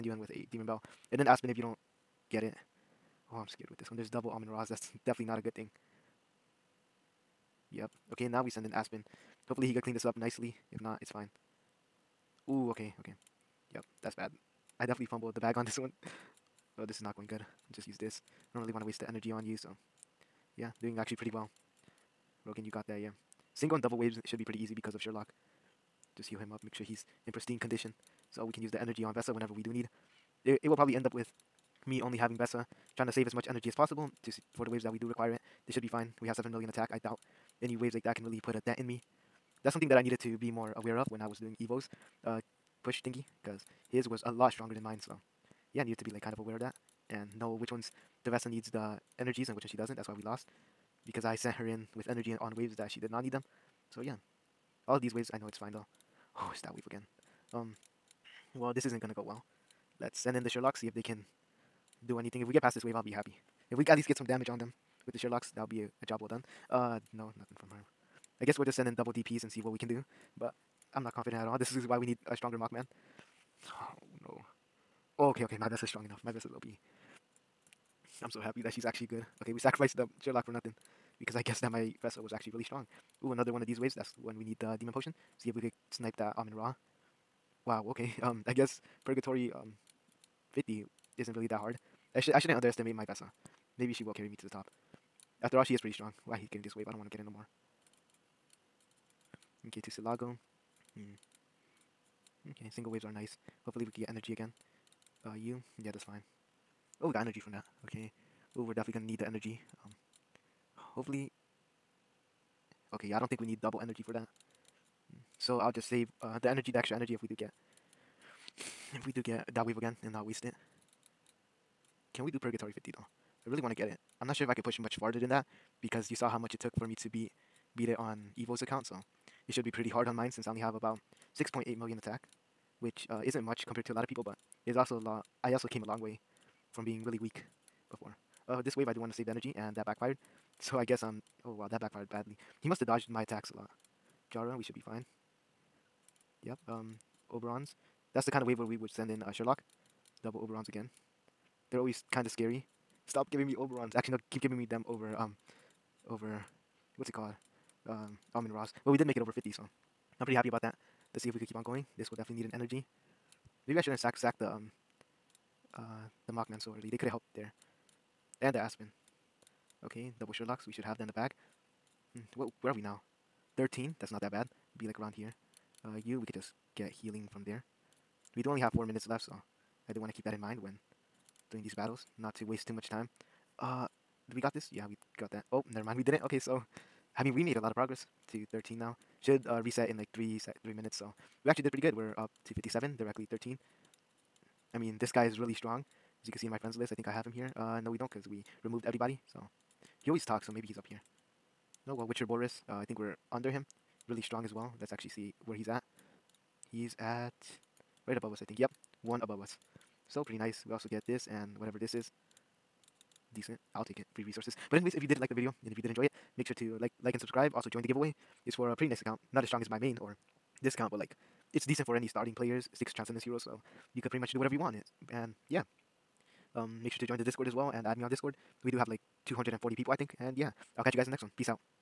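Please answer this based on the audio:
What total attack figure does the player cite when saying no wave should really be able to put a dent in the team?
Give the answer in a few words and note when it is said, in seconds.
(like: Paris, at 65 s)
7 million, at 36 s.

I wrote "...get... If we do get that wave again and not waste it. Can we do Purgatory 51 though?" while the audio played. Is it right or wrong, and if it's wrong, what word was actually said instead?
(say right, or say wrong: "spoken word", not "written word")
wrong: "50", not "51".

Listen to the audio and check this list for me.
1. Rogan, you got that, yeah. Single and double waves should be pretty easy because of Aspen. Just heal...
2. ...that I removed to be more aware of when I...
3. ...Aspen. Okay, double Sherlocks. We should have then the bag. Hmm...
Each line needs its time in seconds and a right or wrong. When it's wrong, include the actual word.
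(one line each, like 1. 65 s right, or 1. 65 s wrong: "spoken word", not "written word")
1. 22 s wrong: "Sherlock", not "Aspen"
2. 39 s wrong: "needed", not "removed"
3. 168 s right.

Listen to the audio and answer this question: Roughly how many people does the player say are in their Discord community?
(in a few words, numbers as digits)
240.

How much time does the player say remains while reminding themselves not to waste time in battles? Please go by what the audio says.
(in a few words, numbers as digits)
4 minutes.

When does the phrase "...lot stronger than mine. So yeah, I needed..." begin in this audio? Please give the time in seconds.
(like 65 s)
44 s.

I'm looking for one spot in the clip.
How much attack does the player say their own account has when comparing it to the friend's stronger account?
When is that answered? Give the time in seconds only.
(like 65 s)
131 s.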